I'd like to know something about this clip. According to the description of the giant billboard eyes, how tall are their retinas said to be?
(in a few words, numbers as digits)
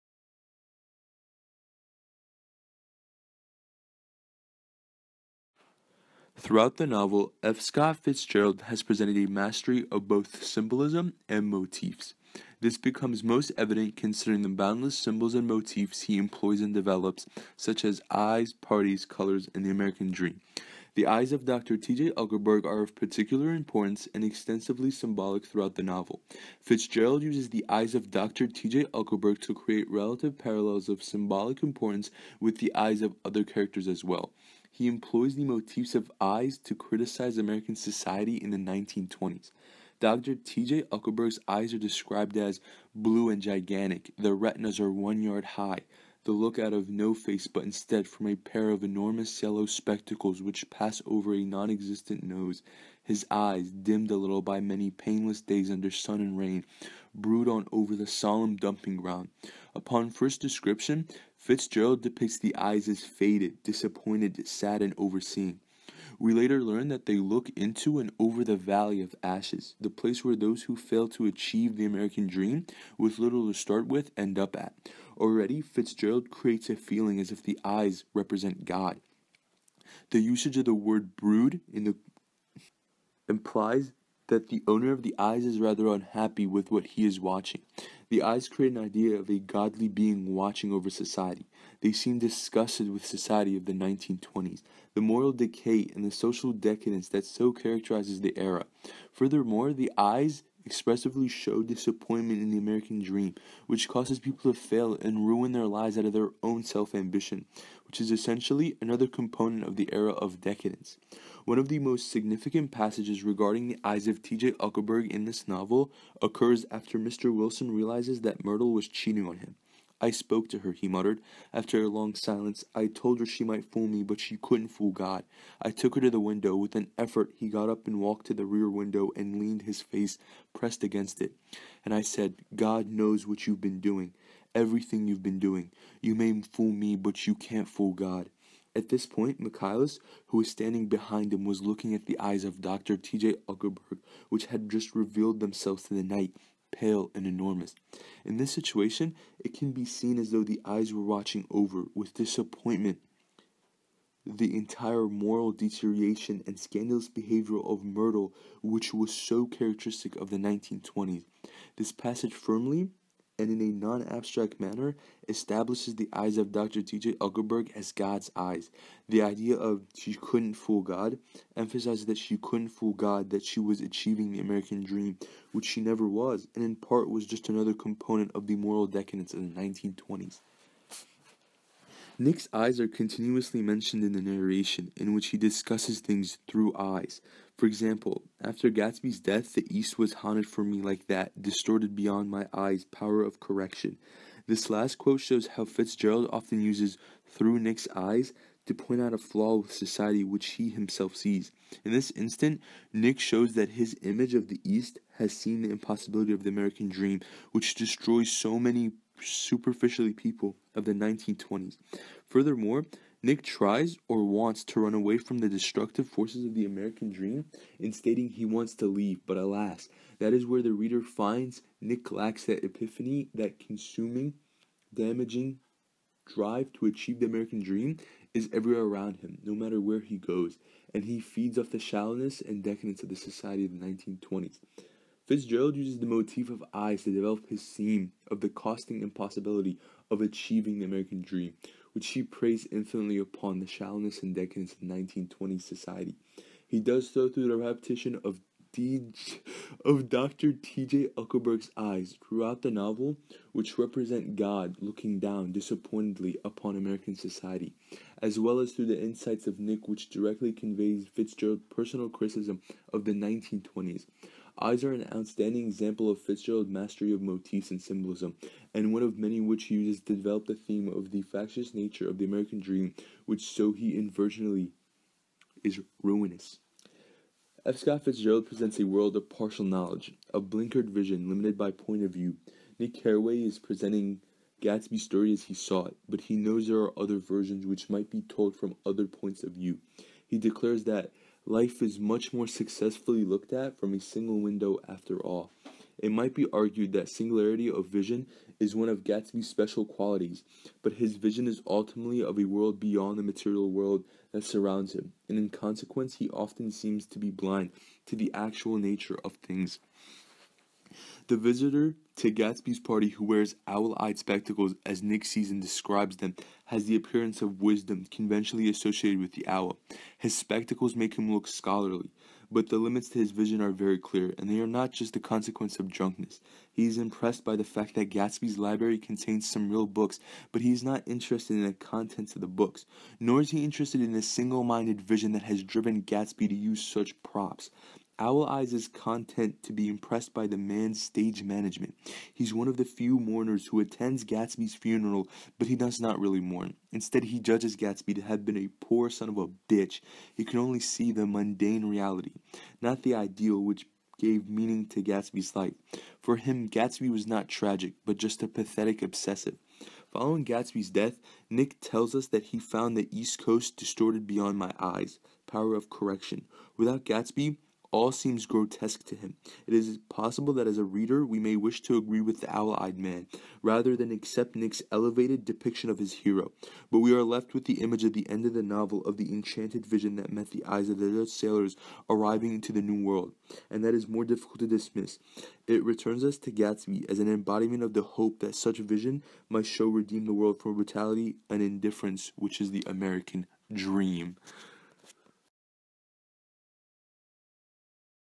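1 yard.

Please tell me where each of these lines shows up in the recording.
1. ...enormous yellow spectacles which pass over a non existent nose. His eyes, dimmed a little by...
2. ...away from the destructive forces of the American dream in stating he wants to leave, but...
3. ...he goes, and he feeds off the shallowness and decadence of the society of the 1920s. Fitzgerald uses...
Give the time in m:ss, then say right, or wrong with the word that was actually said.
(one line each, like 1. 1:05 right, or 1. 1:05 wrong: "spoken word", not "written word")
1. 0:48 right
2. 3:34 right
3. 3:49 right.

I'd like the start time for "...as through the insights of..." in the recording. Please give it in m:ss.
4:18.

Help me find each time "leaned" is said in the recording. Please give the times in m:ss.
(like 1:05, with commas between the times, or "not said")
2:09.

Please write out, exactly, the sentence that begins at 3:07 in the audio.
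For example, after Gatsby's death, the East was haunted for me like that, distorted beyond my eyes, power of correction.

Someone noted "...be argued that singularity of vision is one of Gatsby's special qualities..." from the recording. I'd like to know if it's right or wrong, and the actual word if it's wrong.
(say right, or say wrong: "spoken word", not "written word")
right.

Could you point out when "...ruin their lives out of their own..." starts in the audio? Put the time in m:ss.
1:45.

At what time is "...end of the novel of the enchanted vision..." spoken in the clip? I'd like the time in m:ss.
6:18.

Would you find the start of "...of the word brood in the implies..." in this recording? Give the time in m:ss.
1:20.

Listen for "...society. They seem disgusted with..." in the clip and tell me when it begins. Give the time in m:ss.
1:30.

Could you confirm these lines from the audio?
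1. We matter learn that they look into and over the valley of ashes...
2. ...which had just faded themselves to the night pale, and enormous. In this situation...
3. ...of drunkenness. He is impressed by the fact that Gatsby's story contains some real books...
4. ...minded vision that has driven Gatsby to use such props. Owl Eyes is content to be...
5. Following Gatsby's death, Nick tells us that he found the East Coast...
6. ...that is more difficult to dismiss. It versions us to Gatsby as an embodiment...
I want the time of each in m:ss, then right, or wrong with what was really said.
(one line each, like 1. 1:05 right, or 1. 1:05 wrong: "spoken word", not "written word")
1. 1:06 wrong: "later", not "matter"
2. 2:24 wrong: "revealed", not "faded"
3. 5:25 wrong: "library", not "story"
4. 5:34 right
5. 6:00 right
6. 6:23 wrong: "returns", not "versions".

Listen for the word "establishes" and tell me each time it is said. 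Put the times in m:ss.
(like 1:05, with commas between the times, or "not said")
2:45.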